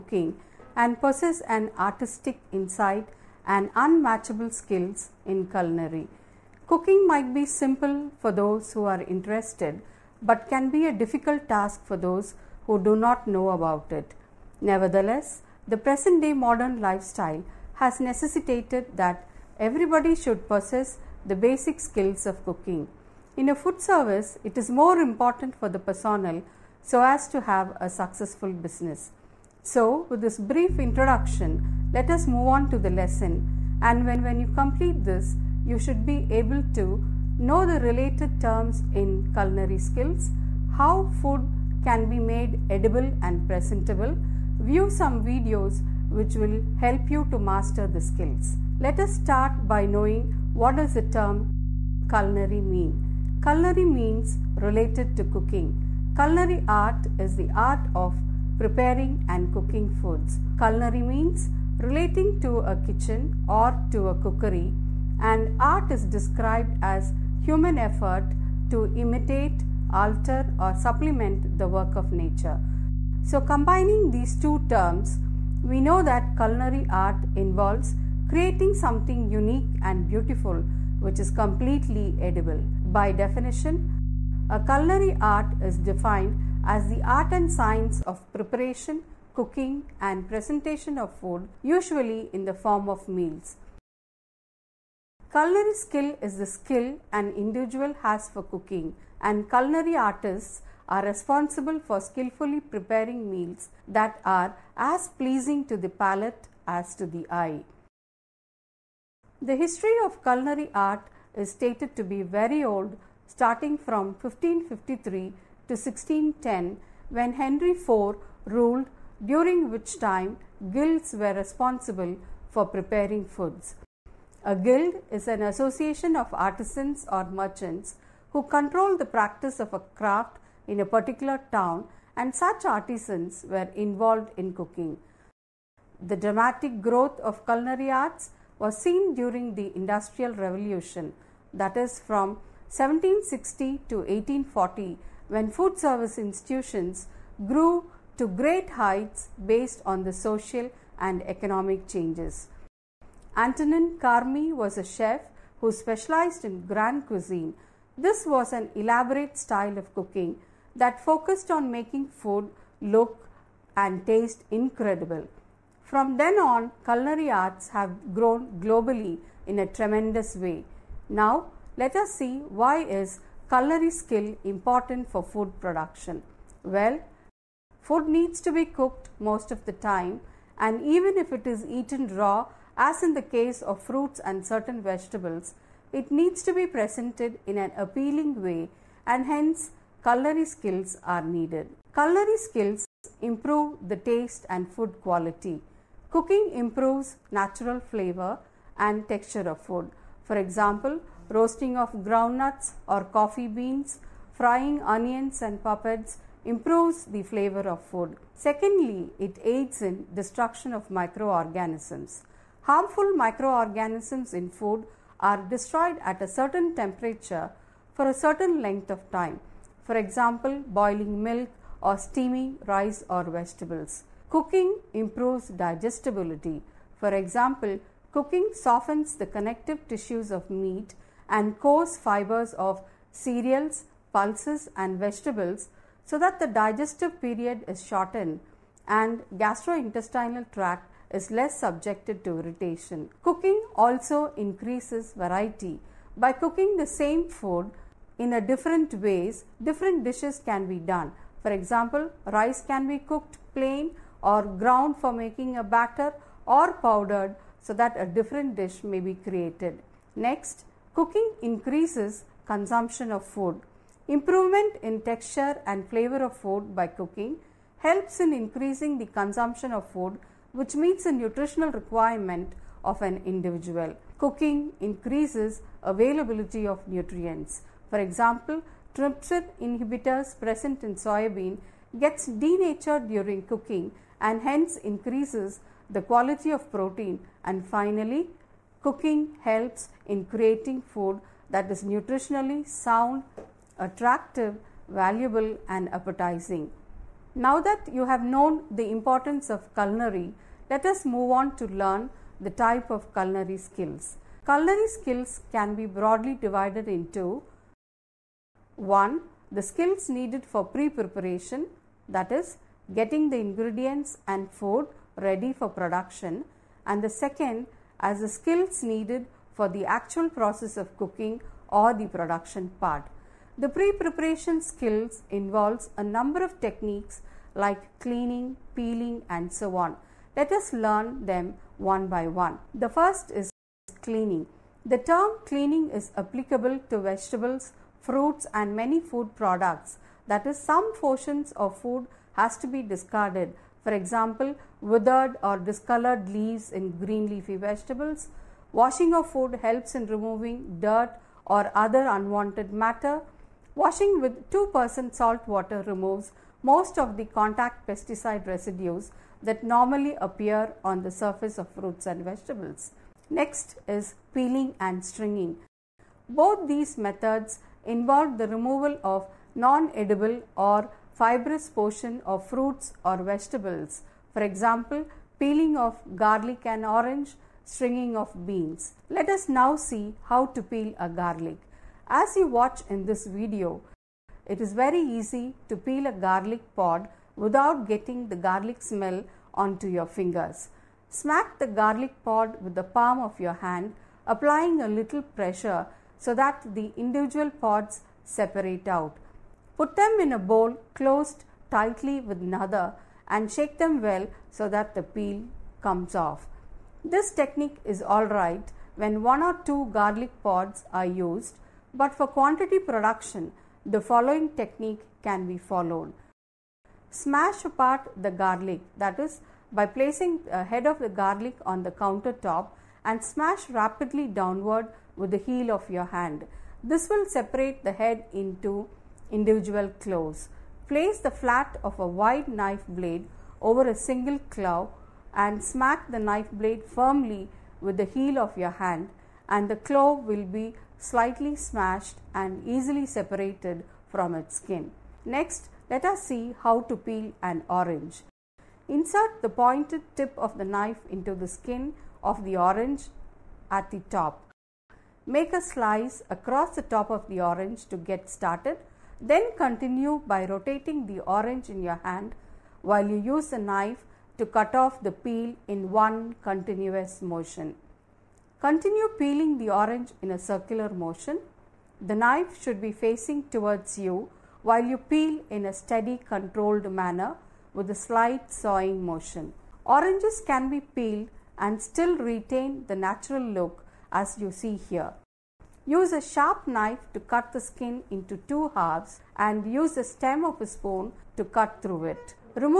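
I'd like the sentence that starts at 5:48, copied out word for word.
Washing of food helps in removing dirt or other unwanted matter.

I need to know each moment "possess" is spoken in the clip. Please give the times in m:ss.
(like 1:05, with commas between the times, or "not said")
0:00, 0:20.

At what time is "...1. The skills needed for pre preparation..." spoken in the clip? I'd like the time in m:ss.
5:08.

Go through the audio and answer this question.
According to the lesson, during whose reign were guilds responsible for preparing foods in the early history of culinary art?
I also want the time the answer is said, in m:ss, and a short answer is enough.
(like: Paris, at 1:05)
Henry IV, at 1:57.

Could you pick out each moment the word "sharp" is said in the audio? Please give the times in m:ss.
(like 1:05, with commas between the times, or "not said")
8:06.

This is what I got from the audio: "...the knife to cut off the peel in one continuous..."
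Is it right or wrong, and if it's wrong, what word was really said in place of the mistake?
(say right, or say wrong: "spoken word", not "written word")
right.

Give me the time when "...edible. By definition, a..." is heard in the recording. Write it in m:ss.
1:22.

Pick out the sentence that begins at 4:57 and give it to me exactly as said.
Now that you have known the importance of culinary, let us move on to learn the type of culinary skills.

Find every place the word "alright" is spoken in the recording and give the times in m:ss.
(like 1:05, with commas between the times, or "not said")
6:48.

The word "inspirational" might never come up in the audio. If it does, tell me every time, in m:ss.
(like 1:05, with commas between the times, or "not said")
not said.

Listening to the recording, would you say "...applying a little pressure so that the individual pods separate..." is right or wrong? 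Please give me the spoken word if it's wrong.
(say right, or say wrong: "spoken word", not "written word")
right.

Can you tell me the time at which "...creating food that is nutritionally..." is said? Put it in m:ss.
4:50.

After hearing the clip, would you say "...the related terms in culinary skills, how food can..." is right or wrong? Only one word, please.
right.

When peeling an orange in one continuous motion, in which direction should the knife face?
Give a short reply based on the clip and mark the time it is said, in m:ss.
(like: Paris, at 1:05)
towards you, at 7:53.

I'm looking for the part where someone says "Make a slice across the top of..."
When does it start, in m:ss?
7:35.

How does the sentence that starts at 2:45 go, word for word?
From then on, culinary arts have grown globally in a tremendous way.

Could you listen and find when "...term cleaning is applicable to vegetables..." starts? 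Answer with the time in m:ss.
5:34.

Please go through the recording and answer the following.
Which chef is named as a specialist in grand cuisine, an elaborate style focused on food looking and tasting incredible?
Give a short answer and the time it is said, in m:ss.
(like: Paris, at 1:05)
Antonin Carême, at 2:33.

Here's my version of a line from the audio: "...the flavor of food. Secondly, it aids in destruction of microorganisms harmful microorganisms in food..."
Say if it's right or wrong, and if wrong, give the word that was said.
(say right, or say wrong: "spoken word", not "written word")
right.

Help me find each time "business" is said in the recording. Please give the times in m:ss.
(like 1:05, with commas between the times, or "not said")
0:28.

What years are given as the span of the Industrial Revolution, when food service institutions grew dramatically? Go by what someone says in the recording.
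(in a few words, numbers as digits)
1760 to 1840.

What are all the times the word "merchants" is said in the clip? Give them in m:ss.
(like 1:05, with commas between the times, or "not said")
2:07.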